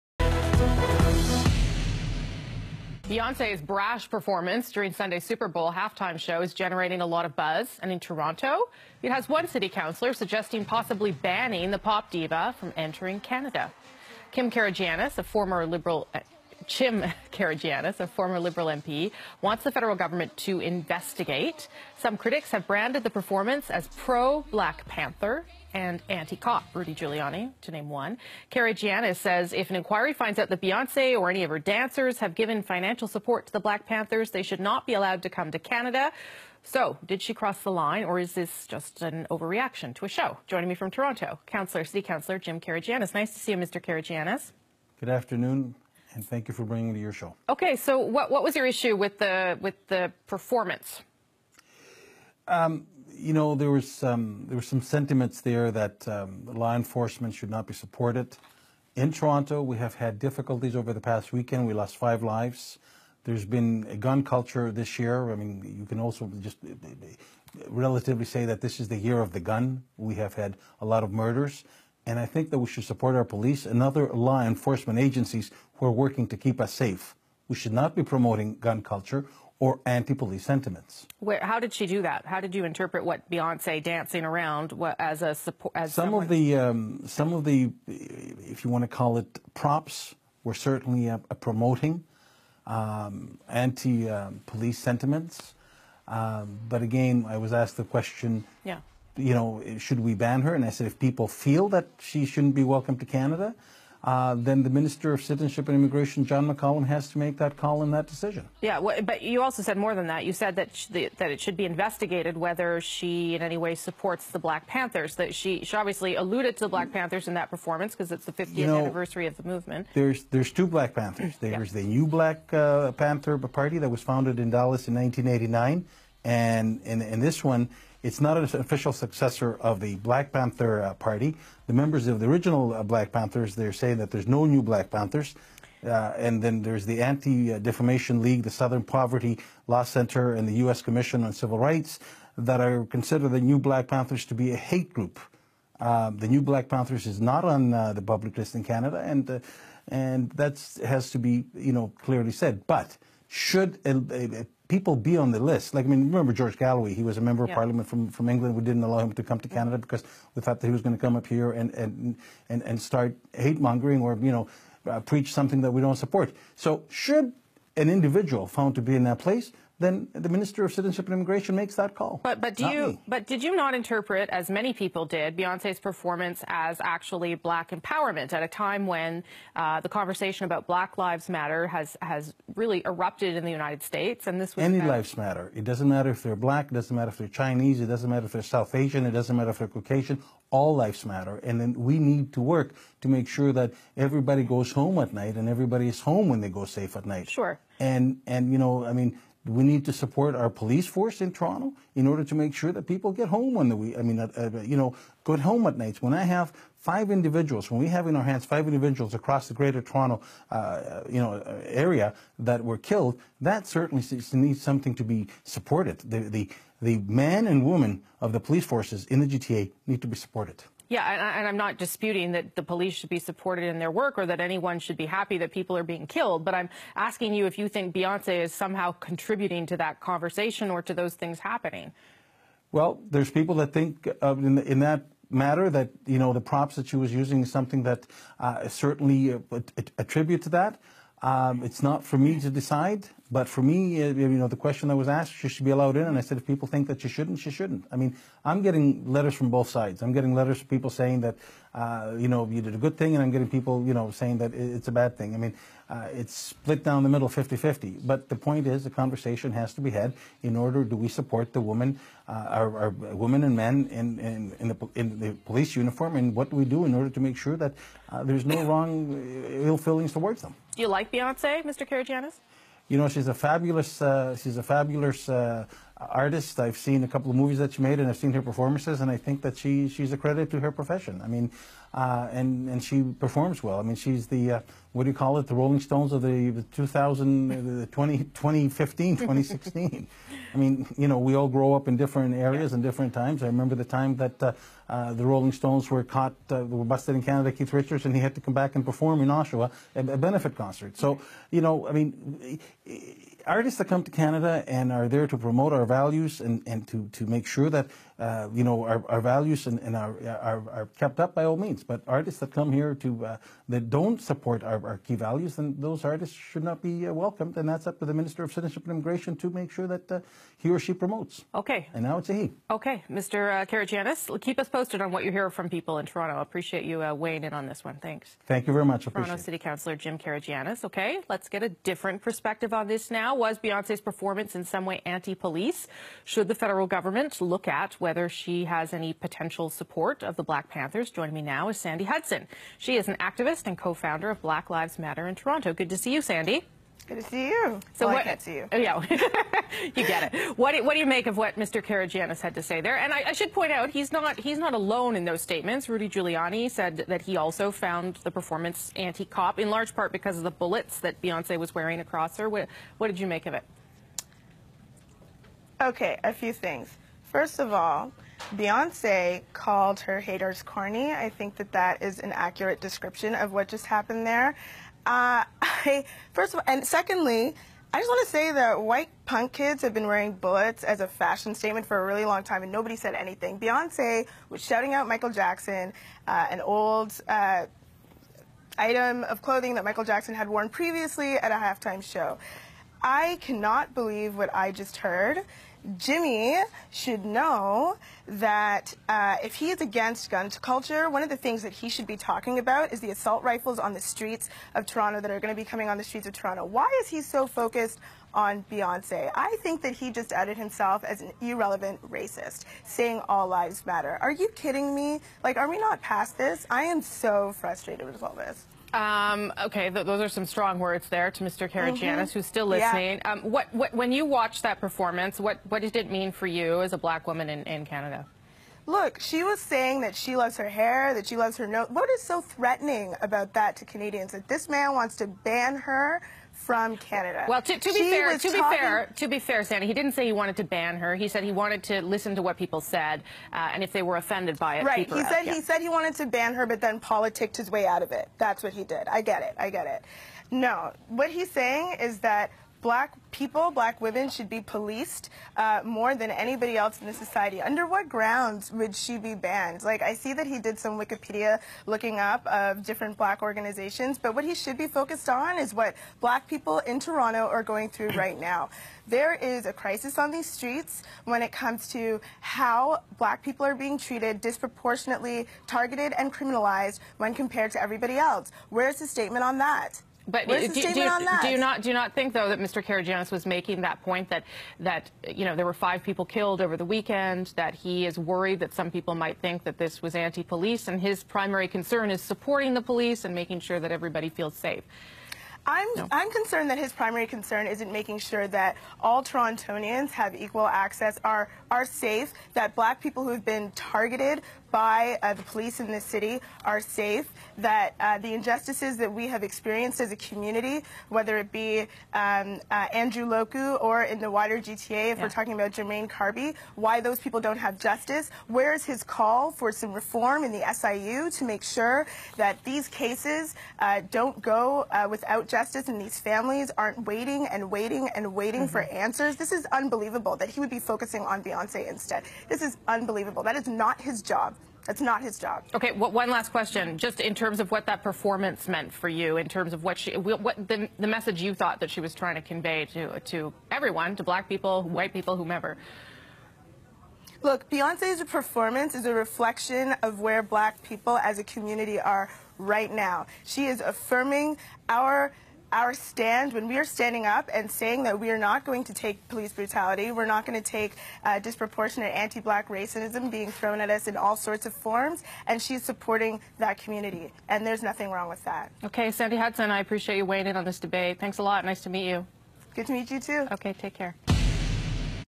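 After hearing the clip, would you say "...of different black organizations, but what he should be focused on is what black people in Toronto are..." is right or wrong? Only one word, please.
right.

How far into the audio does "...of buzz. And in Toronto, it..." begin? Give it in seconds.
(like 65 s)
7 s.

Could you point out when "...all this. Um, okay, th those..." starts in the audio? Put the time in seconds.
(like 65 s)
418 s.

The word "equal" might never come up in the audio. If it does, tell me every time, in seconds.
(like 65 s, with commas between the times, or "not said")
500 s.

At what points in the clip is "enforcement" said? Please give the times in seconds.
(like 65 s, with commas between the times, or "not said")
56 s, 74 s.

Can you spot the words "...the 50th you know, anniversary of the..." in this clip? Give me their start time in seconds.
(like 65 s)
118 s.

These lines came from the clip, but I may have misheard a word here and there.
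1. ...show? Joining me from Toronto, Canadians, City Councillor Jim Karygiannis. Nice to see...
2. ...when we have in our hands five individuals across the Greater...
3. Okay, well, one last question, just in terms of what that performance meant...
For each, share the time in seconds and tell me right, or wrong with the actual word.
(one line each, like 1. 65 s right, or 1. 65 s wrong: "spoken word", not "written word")
1. 40 s wrong: "Councillor", not "Canadians"
2. 207 s right
3. 535 s right.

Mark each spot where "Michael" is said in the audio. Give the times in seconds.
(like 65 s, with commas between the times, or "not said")
385 s, 389 s.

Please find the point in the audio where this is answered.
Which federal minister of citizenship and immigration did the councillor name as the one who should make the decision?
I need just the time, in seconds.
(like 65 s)
106 s.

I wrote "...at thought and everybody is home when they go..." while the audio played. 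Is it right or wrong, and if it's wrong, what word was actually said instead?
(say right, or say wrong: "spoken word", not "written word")
wrong: "night", not "thought".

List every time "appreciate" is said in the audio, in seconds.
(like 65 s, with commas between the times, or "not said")
326 s, 569 s.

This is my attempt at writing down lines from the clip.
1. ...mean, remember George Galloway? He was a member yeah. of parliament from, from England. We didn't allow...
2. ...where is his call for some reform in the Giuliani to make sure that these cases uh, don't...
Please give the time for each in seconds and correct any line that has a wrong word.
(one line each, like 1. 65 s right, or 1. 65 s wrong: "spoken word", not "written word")
1. 155 s right
2. 518 s wrong: "SIU", not "Giuliani".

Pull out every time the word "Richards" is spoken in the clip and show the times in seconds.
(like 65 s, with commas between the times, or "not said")
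297 s.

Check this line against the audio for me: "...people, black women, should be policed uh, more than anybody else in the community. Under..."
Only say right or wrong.
wrong.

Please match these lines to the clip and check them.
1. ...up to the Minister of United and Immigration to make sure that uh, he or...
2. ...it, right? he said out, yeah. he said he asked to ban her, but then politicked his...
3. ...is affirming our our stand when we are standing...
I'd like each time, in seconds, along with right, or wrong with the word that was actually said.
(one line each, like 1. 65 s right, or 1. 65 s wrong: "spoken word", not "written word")
1. 317 s wrong: "Citizenship", not "United"
2. 444 s wrong: "wanted", not "asked"
3. 553 s right.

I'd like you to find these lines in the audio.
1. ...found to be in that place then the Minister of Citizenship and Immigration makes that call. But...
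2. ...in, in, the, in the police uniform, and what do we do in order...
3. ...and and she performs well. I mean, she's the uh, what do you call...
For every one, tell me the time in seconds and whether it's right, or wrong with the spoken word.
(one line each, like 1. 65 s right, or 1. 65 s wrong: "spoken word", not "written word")
1. 168 s right
2. 264 s right
3. 282 s right.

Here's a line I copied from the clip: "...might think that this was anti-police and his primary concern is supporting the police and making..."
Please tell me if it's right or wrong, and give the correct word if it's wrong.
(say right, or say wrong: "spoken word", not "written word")
right.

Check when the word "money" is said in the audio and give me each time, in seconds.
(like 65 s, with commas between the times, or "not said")
not said.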